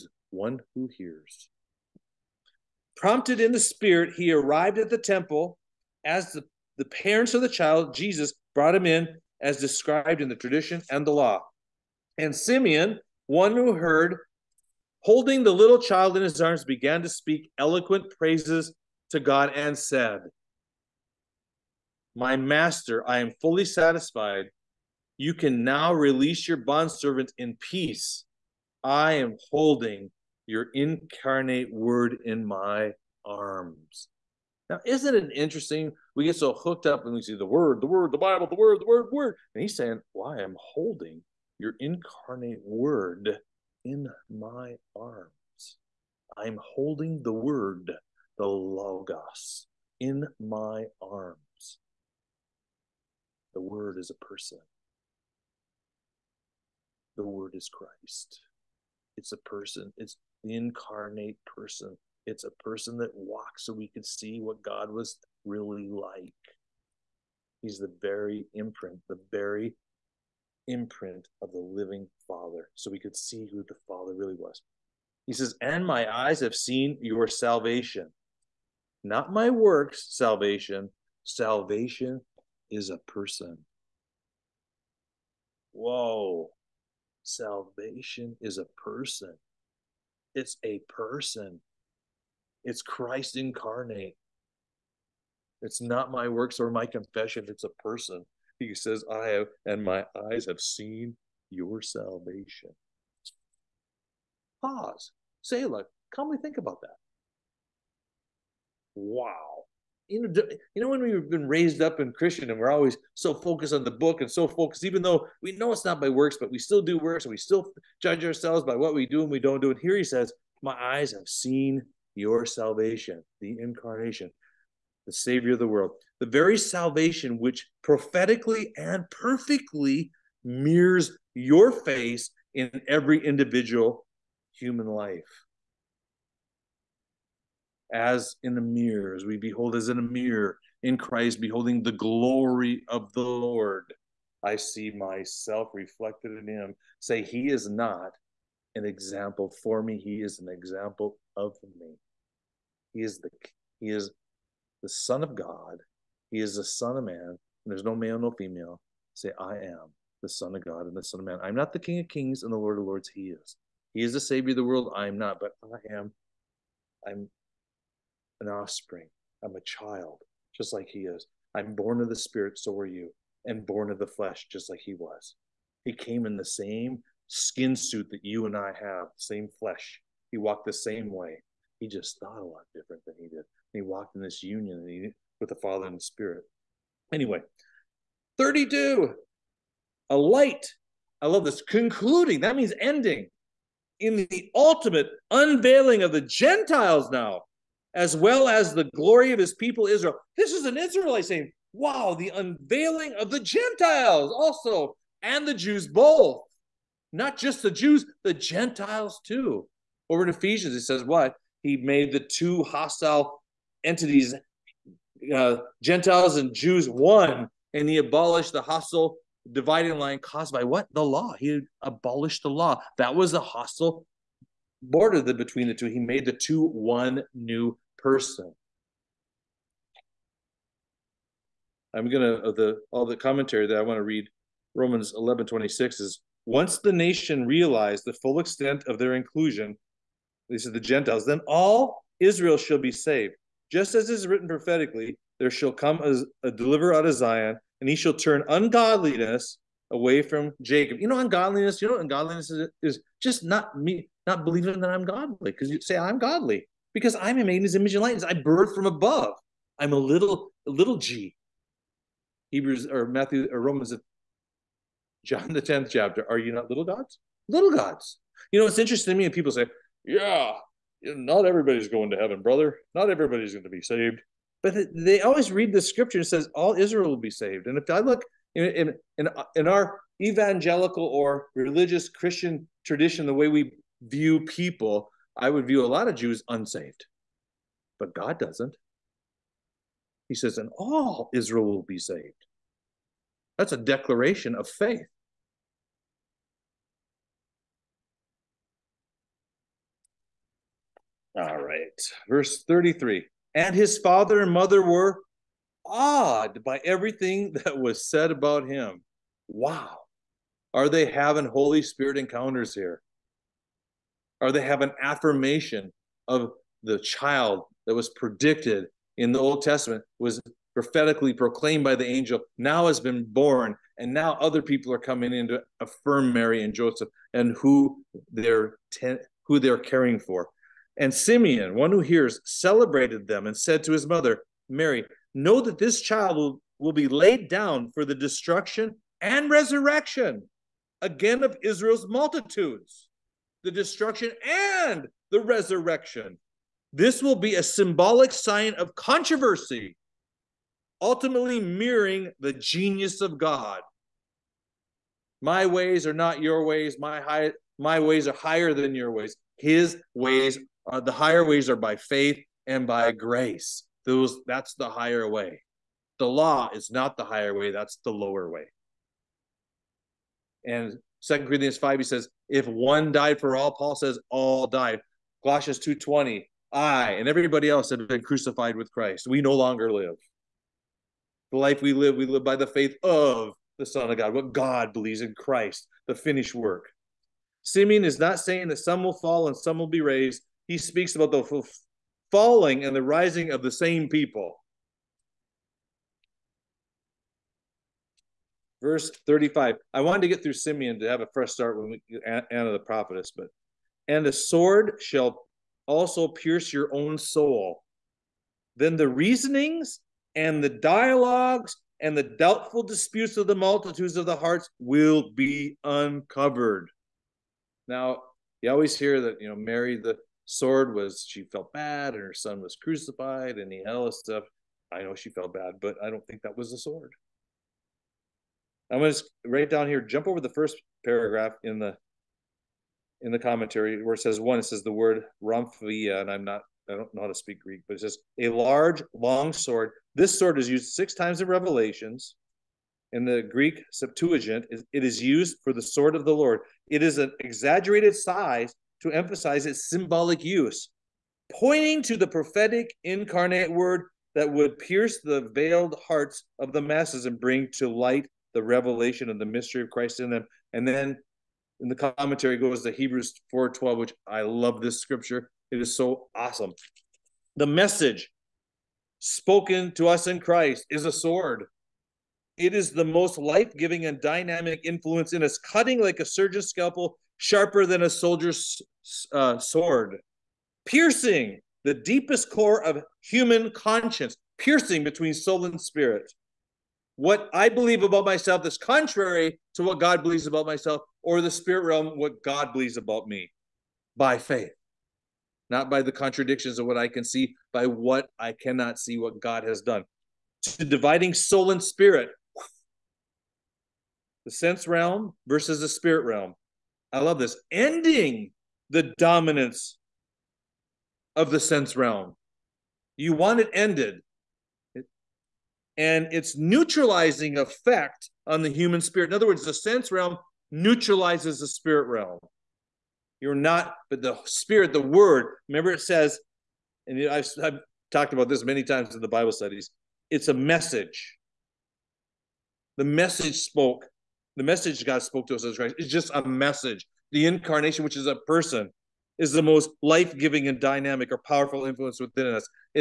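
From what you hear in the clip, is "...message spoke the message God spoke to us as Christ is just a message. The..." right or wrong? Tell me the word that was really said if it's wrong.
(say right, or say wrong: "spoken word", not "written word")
right.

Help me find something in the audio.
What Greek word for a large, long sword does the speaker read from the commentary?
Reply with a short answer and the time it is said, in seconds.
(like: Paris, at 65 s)
Romphia, at 435 s.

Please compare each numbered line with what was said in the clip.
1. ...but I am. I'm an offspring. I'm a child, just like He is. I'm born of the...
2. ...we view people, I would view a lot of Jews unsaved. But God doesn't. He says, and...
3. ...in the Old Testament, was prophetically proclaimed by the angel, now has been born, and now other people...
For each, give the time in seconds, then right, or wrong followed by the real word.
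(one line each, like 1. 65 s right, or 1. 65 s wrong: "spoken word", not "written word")
1. 165 s right
2. 283 s right
3. 319 s right.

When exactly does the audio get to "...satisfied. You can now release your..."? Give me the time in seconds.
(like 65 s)
23 s.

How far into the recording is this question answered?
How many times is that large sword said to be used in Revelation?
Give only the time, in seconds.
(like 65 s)
440 s.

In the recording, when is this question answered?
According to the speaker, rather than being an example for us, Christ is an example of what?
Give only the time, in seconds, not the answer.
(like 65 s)
151 s.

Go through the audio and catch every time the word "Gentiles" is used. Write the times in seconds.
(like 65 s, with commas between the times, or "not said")
196 s, 203 s, 208 s, 215 s, 240 s.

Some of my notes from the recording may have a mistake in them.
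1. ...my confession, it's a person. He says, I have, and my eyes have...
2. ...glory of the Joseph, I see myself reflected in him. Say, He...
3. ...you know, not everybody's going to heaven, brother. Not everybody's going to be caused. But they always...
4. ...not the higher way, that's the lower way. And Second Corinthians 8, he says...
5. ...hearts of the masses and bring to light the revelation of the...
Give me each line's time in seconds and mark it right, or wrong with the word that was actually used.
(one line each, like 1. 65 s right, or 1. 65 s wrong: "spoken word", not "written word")
1. 96 s right
2. 141 s wrong: "Lord", not "Joseph"
3. 271 s wrong: "saved", not "caused"
4. 366 s wrong: "5", not "8"
5. 456 s right.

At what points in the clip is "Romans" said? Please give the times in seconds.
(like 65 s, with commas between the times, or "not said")
234 s, 263 s.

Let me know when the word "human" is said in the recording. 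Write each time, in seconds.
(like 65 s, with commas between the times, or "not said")
134 s, 483 s, 518 s.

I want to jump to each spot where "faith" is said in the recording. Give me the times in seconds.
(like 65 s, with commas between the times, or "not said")
294 s, 361 s, 382 s, 494 s.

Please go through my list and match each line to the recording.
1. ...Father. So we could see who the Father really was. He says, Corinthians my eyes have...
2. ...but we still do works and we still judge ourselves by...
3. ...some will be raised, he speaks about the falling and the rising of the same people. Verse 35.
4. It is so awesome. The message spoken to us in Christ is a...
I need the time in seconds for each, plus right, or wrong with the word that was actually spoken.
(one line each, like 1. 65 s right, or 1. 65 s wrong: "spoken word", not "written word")
1. 72 s wrong: "And", not "Corinthians"
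2. 116 s right
3. 389 s right
4. 465 s right.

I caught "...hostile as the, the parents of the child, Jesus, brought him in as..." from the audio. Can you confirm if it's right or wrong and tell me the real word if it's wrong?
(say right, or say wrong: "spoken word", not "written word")
wrong: "temple", not "hostile".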